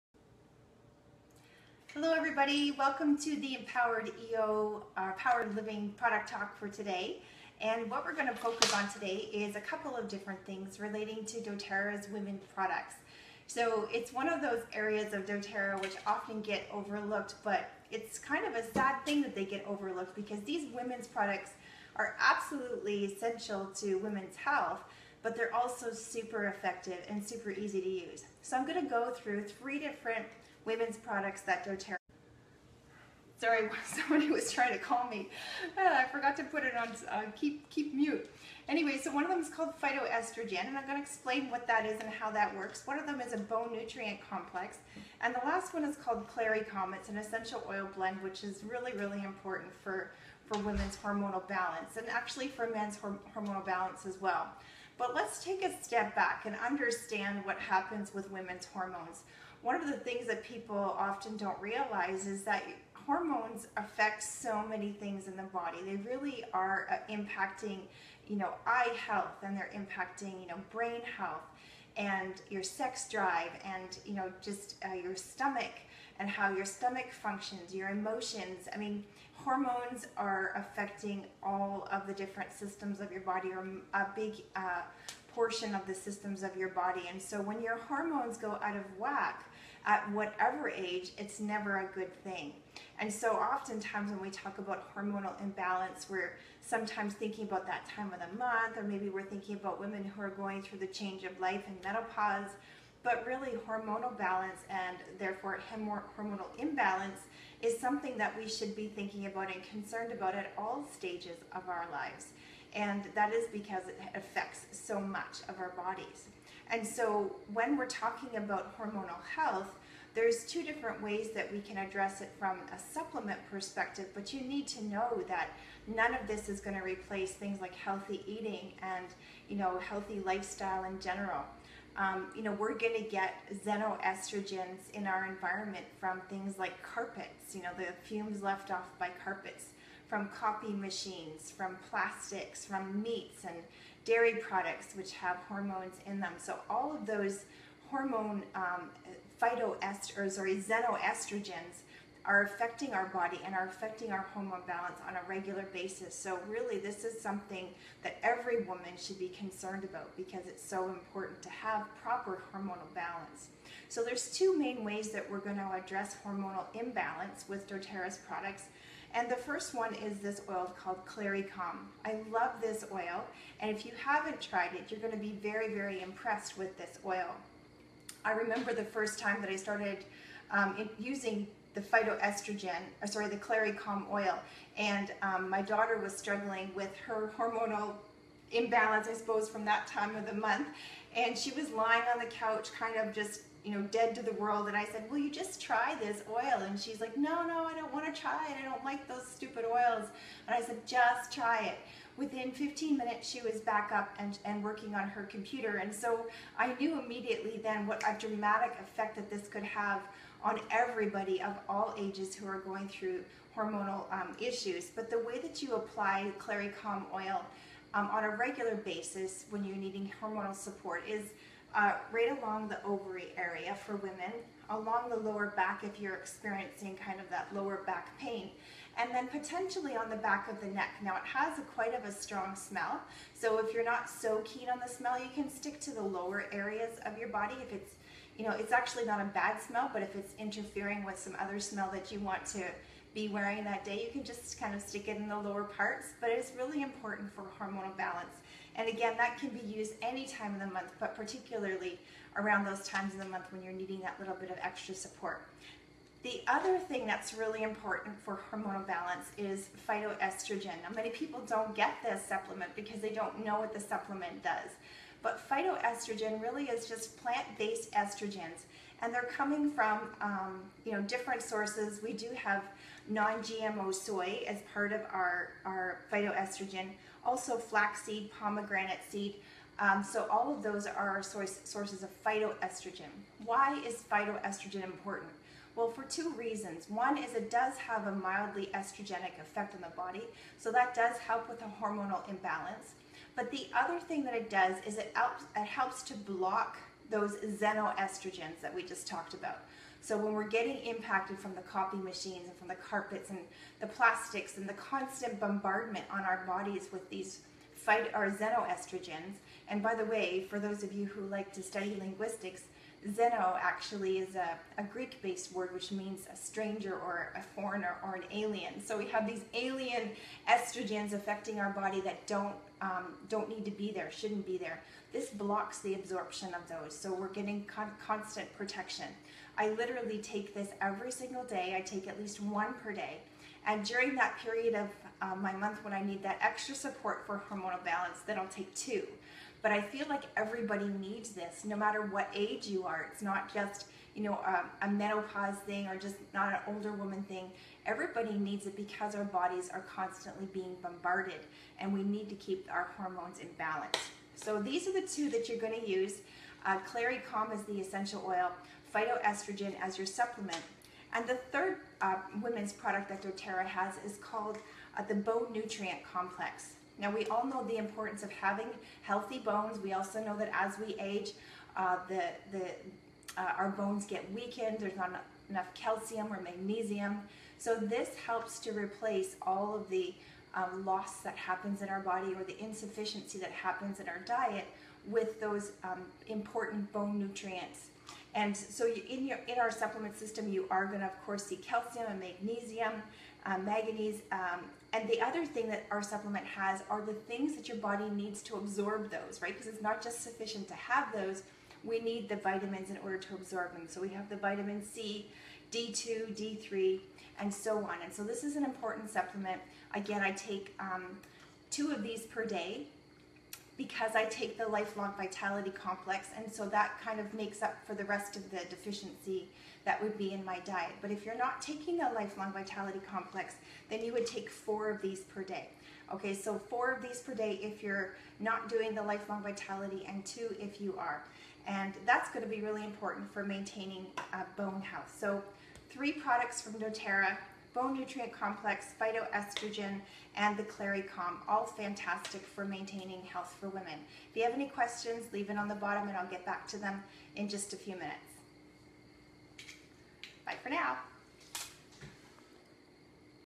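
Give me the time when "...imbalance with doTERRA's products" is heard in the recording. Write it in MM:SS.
02:46.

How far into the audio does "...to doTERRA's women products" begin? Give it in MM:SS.
00:11.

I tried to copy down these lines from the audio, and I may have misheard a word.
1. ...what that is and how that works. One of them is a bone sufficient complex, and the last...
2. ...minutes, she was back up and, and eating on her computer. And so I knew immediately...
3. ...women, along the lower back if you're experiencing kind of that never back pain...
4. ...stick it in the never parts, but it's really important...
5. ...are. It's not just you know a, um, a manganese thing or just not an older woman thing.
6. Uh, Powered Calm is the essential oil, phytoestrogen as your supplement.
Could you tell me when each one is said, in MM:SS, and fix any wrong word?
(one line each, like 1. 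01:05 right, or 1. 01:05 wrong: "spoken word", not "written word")
1. 00:41 wrong: "nutrient", not "sufficient"
2. 03:22 wrong: "working", not "eating"
3. 03:43 wrong: "lower", not "never"
4. 04:04 wrong: "lower", not "never"
5. 05:42 wrong: "menopause", not "manganese"
6. 05:56 wrong: "Clary", not "Powered".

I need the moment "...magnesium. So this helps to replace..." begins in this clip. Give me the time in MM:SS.
06:16.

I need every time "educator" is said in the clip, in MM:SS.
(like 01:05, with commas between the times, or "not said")
not said.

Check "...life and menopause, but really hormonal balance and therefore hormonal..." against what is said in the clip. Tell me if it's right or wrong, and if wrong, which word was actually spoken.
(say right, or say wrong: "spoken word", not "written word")
right.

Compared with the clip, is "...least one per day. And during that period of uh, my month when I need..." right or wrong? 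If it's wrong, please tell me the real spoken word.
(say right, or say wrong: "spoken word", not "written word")
right.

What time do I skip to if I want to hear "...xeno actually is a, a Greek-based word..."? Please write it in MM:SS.
05:13.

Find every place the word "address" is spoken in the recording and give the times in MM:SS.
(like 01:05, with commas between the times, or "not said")
02:01, 02:45.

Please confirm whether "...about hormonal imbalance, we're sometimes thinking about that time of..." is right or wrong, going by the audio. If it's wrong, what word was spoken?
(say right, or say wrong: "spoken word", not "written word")
right.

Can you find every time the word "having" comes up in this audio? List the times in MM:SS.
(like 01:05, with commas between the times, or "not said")
06:08.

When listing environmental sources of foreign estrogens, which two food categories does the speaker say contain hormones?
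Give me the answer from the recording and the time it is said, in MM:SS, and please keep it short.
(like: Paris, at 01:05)
meats and dairy products, at 02:23.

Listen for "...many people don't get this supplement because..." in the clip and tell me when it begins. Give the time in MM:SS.
04:20.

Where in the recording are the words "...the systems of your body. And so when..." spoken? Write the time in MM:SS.
01:25.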